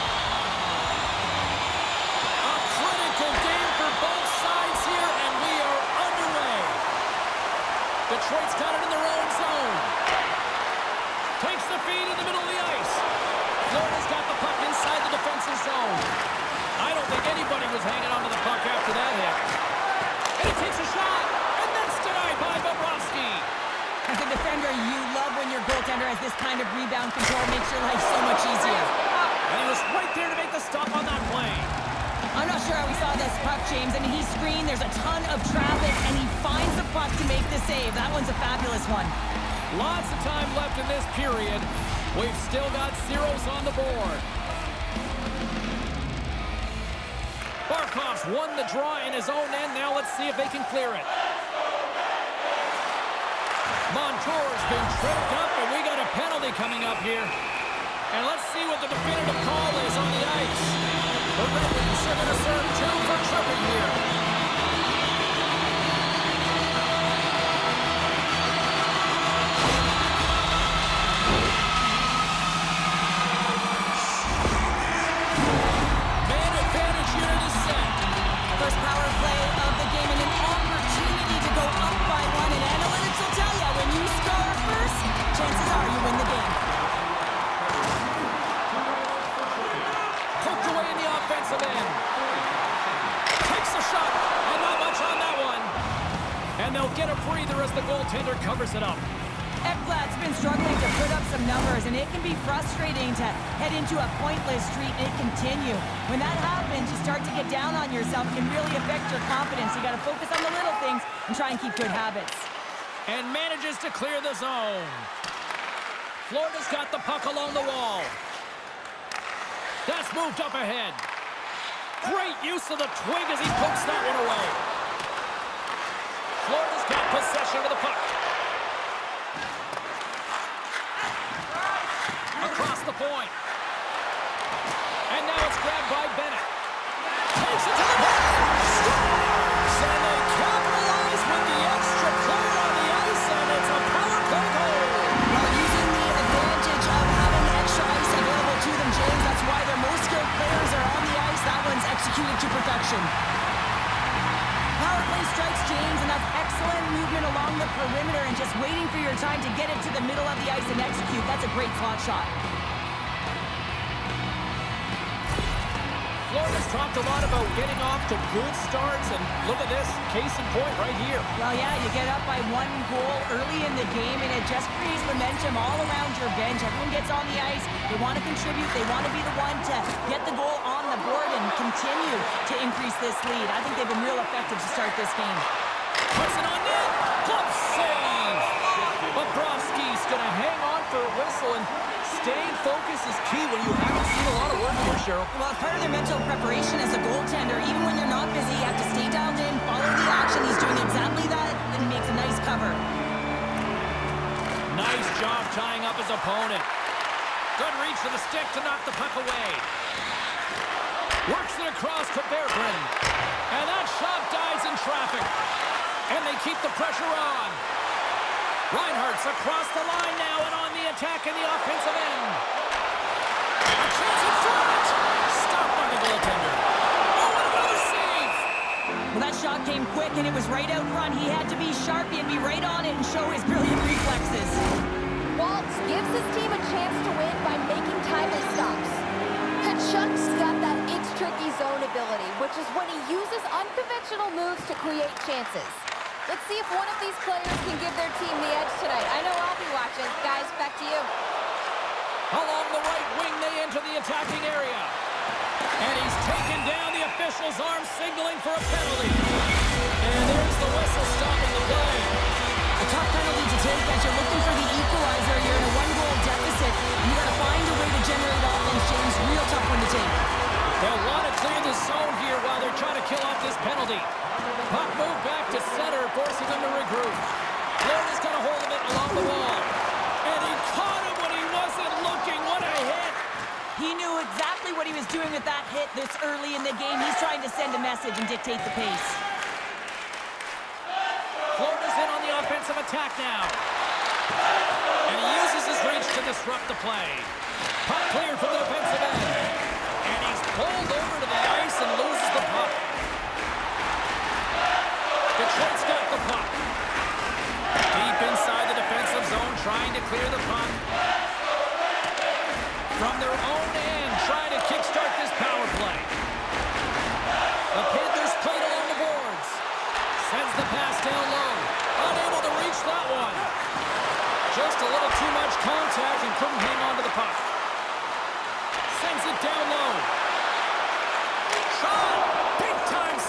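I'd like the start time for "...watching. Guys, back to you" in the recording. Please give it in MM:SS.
04:09.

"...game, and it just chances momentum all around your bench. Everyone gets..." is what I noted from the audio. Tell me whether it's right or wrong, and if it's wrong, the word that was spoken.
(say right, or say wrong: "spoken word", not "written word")
wrong: "creates", not "chances".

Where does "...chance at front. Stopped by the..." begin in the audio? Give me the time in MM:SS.
03:43.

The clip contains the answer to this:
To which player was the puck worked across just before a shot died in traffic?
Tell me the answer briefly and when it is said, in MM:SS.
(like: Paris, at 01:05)
Berggren, at 03:32.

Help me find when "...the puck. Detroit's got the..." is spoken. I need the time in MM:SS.
05:02.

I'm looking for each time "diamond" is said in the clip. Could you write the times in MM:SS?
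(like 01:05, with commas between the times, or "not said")
not said.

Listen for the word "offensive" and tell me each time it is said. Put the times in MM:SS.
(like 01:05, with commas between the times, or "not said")
03:41, 04:52.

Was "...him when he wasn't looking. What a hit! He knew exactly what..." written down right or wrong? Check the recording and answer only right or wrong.
right.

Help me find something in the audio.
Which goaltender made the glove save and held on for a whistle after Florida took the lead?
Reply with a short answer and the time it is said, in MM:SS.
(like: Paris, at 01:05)
Bobrovsky, at 03:09.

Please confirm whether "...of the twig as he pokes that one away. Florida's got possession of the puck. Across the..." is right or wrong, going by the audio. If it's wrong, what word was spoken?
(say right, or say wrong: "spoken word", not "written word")
right.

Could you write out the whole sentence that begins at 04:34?
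Puck move back to center, forcing them to regroup.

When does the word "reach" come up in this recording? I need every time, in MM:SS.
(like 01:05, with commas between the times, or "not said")
03:27, 04:55, 05:22.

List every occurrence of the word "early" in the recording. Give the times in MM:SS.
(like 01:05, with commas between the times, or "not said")
02:53, 04:46.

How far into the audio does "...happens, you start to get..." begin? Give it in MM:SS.
01:46.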